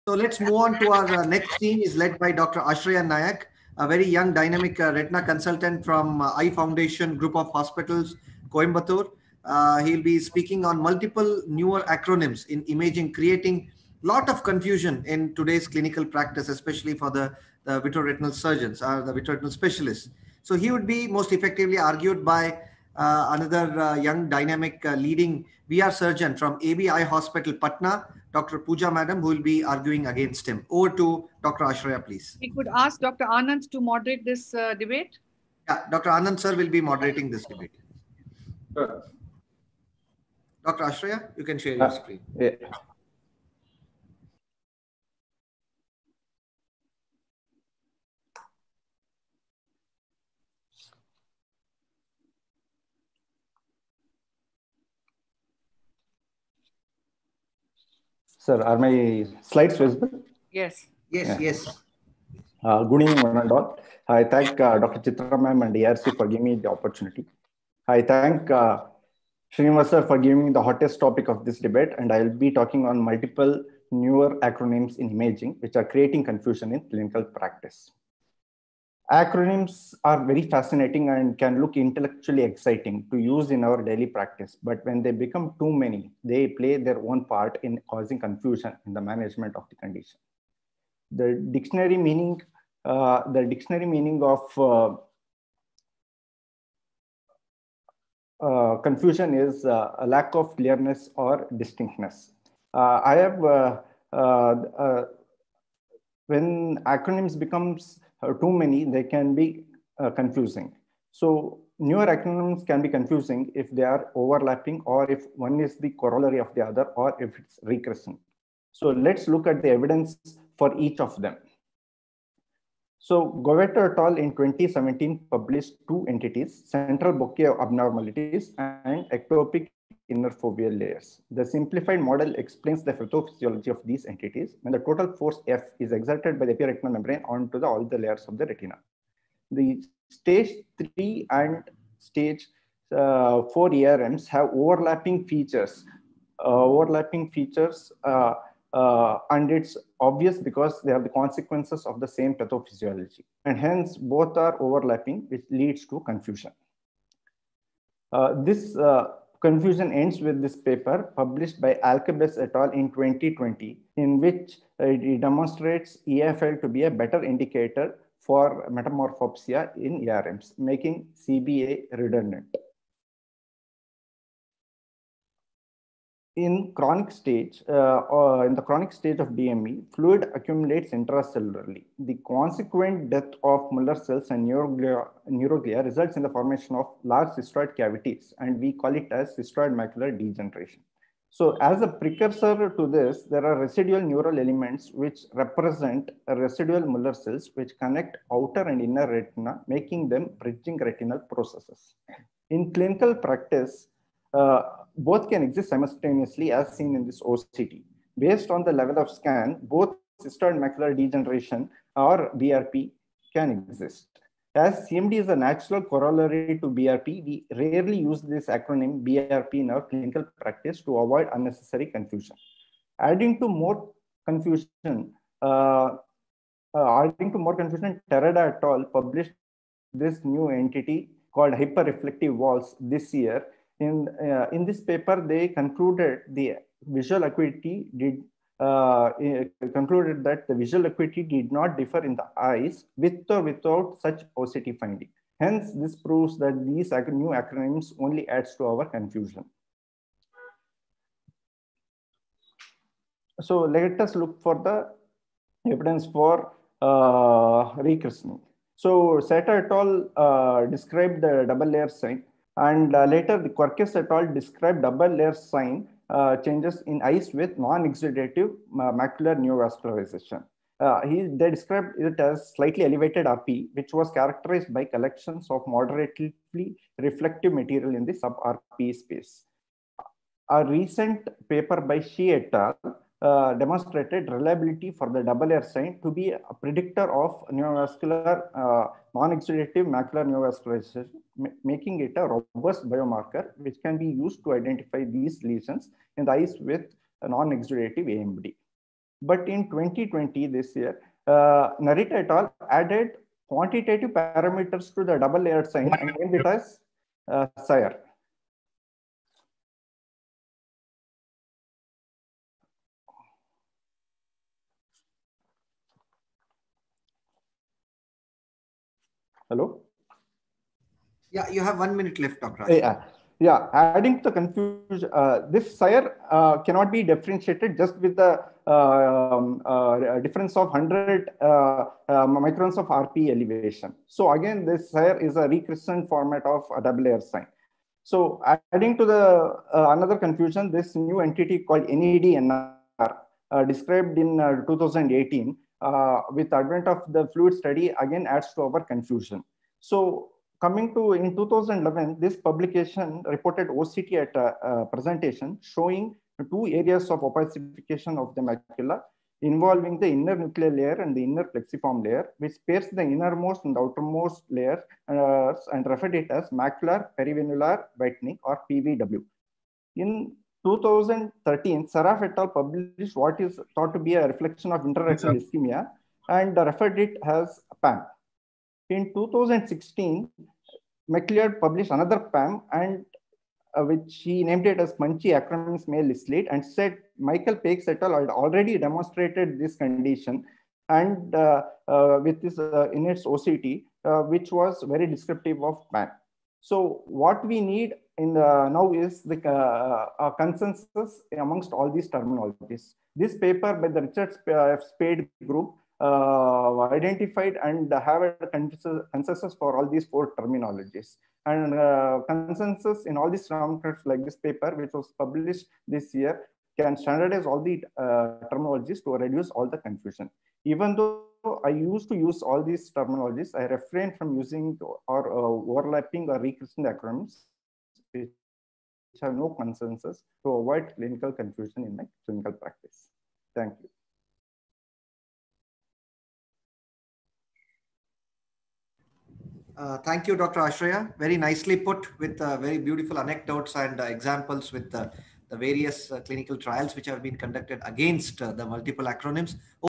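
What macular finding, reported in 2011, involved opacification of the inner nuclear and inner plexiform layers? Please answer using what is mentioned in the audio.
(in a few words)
perivenular whitening.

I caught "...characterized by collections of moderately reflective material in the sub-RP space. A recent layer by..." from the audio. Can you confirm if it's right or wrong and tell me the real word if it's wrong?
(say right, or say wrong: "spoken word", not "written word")
wrong: "paper", not "layer".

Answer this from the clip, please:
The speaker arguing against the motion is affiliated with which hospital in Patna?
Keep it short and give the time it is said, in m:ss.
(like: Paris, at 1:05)
ABI Hospital, at 0:26.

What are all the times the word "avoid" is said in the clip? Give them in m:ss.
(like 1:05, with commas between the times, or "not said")
3:40, 7:10.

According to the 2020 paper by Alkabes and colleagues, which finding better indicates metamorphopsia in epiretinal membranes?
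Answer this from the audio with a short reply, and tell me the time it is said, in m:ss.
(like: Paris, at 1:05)
EFL, at 2:46.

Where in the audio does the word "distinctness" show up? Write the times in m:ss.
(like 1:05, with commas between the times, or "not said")
1:41.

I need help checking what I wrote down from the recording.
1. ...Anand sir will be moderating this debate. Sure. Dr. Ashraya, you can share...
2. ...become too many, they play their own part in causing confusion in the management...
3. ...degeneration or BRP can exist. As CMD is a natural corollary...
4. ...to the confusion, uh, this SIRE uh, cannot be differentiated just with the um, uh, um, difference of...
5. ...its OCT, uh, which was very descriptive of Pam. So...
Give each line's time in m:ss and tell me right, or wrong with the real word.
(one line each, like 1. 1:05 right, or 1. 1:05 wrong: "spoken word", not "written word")
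1. 0:36 right
2. 1:25 right
3. 3:30 right
4. 5:24 right
5. 6:33 right.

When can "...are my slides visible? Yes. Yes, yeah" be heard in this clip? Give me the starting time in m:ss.
0:58.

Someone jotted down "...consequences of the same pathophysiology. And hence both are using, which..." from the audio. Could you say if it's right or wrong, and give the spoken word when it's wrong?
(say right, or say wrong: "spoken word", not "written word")
wrong: "overlapping", not "using".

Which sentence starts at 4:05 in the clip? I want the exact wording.
Hence, this proves that these new acronyms only adds to our confusion.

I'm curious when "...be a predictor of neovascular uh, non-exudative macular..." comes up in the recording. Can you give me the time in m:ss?
4:46.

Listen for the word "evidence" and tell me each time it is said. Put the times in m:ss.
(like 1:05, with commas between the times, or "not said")
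1:59, 4:15.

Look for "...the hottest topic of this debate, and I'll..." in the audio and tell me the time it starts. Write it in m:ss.
1:10.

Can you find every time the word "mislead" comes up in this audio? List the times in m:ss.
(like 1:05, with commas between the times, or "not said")
6:26.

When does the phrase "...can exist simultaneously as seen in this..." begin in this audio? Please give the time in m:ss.
3:25.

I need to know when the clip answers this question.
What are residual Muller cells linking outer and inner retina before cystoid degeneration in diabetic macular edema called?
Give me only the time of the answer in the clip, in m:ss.
3:20.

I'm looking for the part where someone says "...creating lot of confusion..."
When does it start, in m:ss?
0:13.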